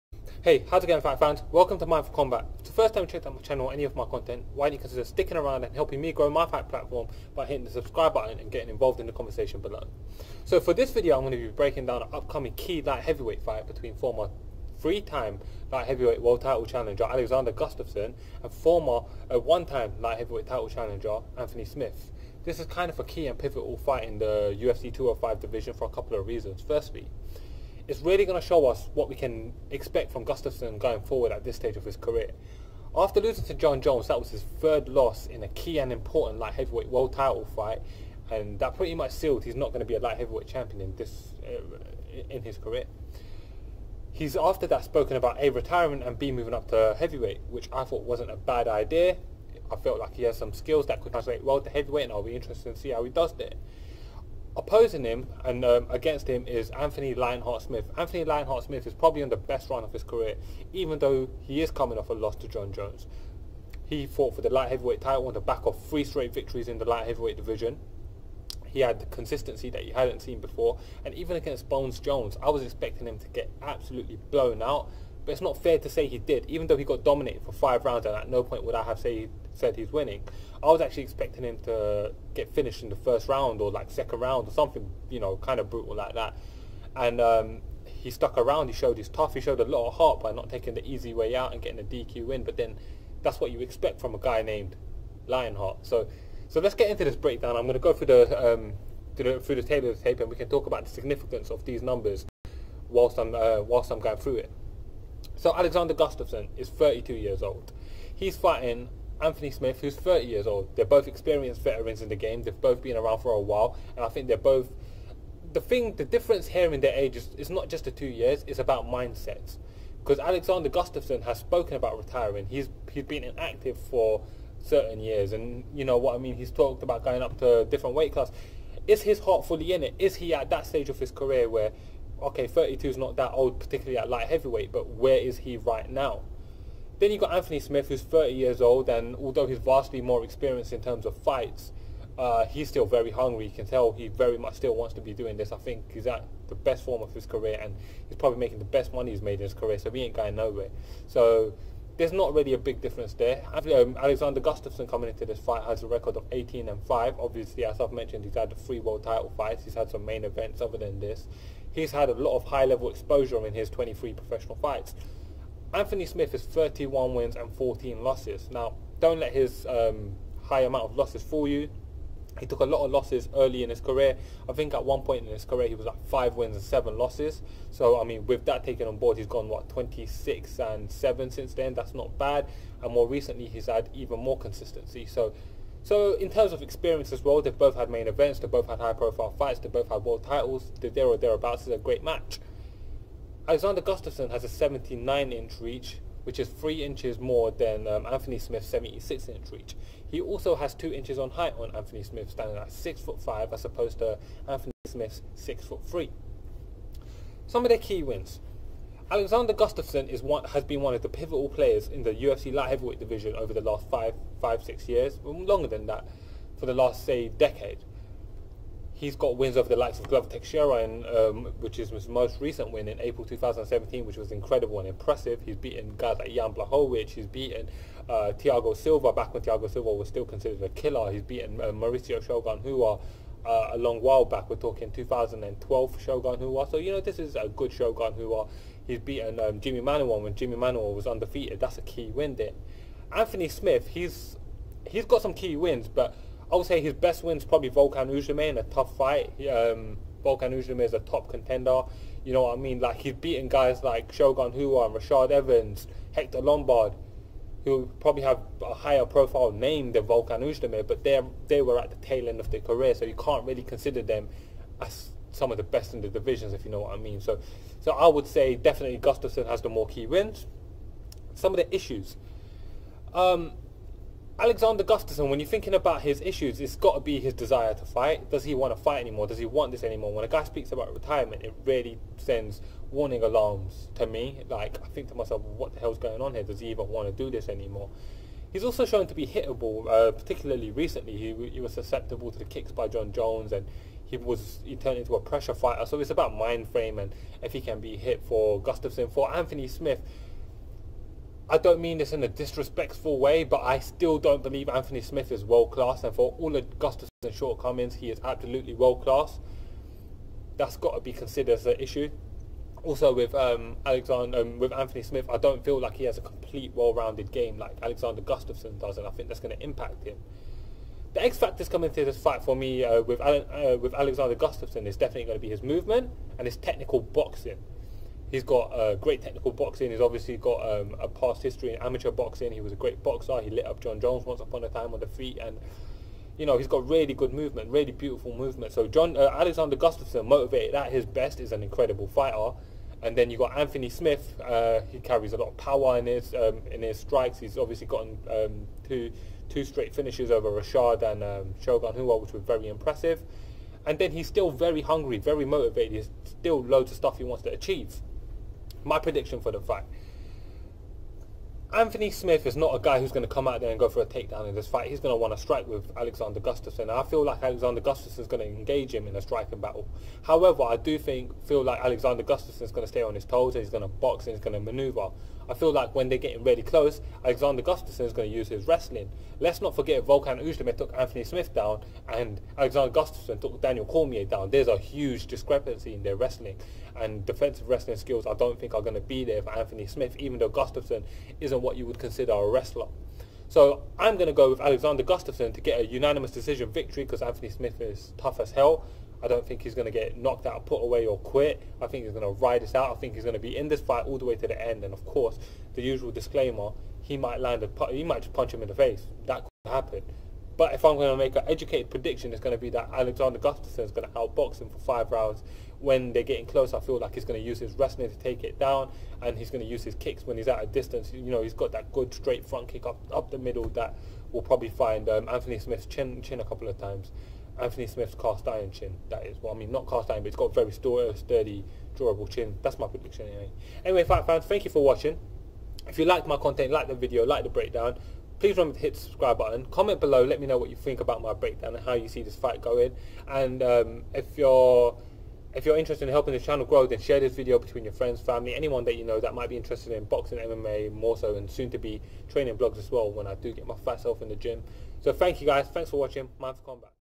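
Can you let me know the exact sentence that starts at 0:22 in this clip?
This is kind of a key and pivotal fight in the UFC 205 division for a couple of reasons.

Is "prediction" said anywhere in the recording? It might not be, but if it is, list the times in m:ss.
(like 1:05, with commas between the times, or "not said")
5:58, 6:51, 7:12.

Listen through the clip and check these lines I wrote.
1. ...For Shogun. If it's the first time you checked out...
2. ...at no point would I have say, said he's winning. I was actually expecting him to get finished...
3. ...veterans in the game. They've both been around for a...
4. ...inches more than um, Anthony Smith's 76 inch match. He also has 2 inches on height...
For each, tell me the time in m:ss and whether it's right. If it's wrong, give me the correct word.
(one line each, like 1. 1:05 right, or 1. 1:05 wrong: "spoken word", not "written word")
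1. 0:02 wrong: "Combat", not "Shogun"
2. 1:18 right
3. 1:51 right
4. 3:16 wrong: "reach", not "match".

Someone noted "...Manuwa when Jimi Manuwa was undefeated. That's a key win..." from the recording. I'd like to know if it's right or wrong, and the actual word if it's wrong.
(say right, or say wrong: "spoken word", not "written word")
right.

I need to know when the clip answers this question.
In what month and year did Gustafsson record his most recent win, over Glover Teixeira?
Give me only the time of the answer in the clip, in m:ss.
3:43.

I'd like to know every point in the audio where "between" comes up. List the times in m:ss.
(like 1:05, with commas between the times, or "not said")
0:13, 7:27.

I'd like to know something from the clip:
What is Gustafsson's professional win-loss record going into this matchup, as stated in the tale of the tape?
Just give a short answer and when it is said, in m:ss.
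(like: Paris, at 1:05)
18-5, at 2:36.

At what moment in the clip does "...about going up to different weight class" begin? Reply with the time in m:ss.
2:06.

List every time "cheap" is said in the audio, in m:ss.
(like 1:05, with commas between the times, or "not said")
not said.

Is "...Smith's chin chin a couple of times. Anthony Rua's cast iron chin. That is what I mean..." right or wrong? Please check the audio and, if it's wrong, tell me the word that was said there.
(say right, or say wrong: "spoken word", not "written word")
wrong: "Smith", not "Rua".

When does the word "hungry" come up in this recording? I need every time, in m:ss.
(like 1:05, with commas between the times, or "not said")
2:23, 5:54.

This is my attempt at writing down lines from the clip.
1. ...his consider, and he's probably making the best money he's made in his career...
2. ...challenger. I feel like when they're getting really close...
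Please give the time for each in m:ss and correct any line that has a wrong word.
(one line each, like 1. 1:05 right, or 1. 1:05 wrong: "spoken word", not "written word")
1. 2:27 wrong: "career", not "consider"
2. 6:14 wrong: "maneuver", not "challenger".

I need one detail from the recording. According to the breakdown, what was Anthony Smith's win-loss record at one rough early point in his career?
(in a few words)
5-7.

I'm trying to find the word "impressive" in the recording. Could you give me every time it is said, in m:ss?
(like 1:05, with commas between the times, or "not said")
3:44, 5:52.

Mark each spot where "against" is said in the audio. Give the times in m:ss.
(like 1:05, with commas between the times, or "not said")
0:55, 1:11.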